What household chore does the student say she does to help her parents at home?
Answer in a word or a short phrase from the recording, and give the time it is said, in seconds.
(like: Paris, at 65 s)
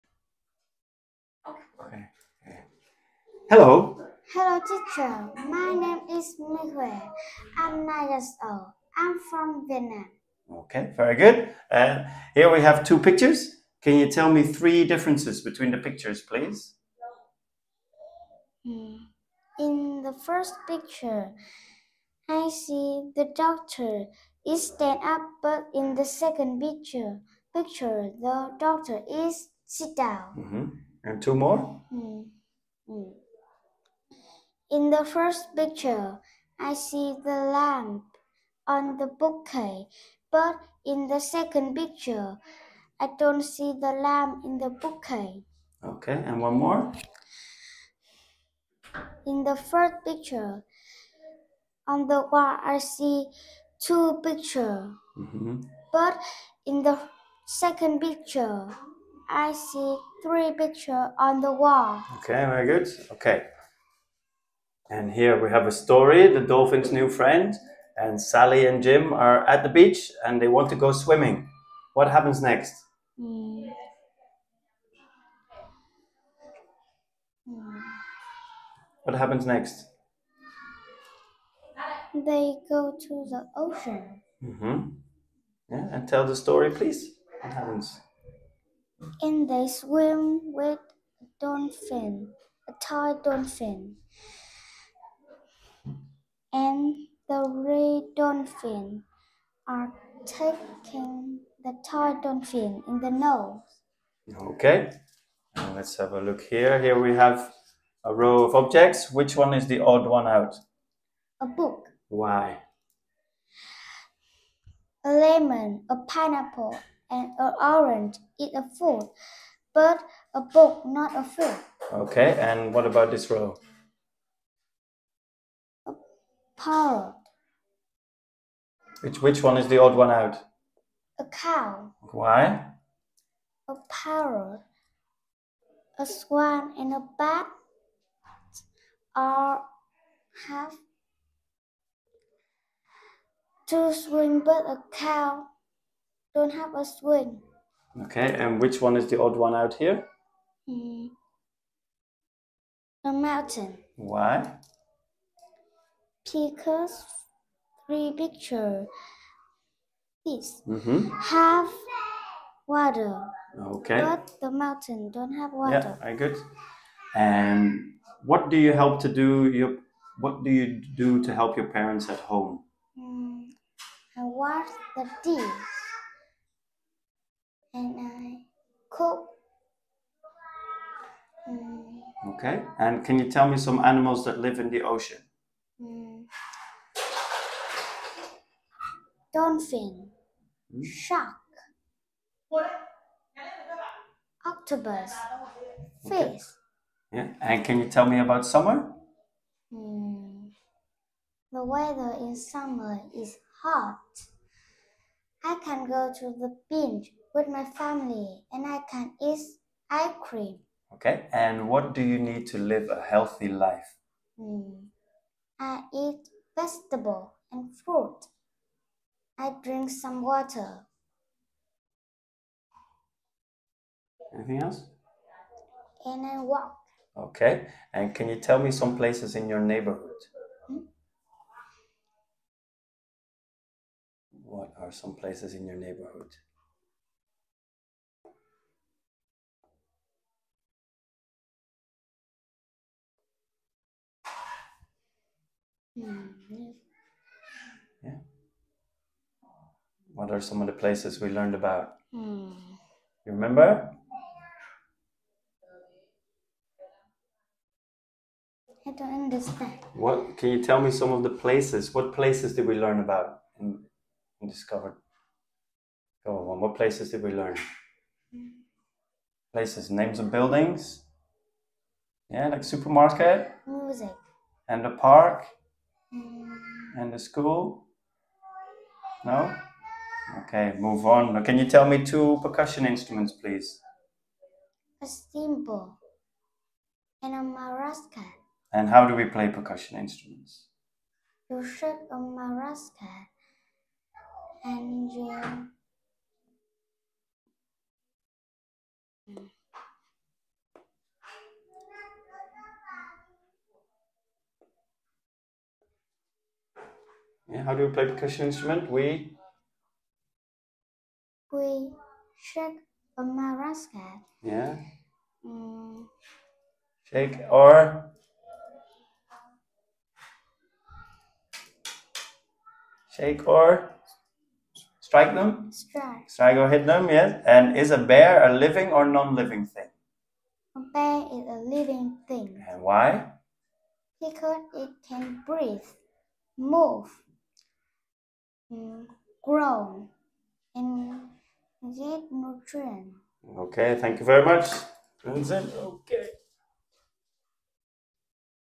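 Wash the dishes, at 174 s.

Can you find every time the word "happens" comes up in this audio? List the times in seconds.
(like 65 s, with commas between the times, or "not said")
72 s, 79 s, 87 s.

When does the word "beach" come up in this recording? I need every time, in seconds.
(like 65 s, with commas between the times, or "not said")
69 s, 206 s.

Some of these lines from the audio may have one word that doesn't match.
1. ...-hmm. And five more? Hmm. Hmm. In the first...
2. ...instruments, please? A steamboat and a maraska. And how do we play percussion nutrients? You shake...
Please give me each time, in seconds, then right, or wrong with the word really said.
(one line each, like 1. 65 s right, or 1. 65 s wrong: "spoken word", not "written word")
1. 30 s wrong: "two", not "five"
2. 282 s wrong: "instruments", not "nutrients".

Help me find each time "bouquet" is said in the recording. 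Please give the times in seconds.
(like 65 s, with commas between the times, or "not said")
39 s, 44 s.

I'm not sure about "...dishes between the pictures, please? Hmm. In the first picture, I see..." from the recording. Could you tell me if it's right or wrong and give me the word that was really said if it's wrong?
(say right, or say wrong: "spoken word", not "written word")
wrong: "differences", not "dishes".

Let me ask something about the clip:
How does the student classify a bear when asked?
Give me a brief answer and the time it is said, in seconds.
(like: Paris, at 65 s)
A living thing, at 330 s.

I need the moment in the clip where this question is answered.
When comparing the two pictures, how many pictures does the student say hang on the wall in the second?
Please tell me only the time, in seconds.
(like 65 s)
60 s.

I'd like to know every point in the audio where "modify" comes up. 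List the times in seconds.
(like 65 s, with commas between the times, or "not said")
not said.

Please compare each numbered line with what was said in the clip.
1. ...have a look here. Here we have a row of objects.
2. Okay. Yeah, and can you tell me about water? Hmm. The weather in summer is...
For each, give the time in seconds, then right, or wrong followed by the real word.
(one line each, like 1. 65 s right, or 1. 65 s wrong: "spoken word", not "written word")
1. 105 s right
2. 196 s wrong: "summer", not "water".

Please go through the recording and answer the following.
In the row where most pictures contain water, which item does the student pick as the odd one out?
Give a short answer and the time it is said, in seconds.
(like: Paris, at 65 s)
A mountain, at 153 s.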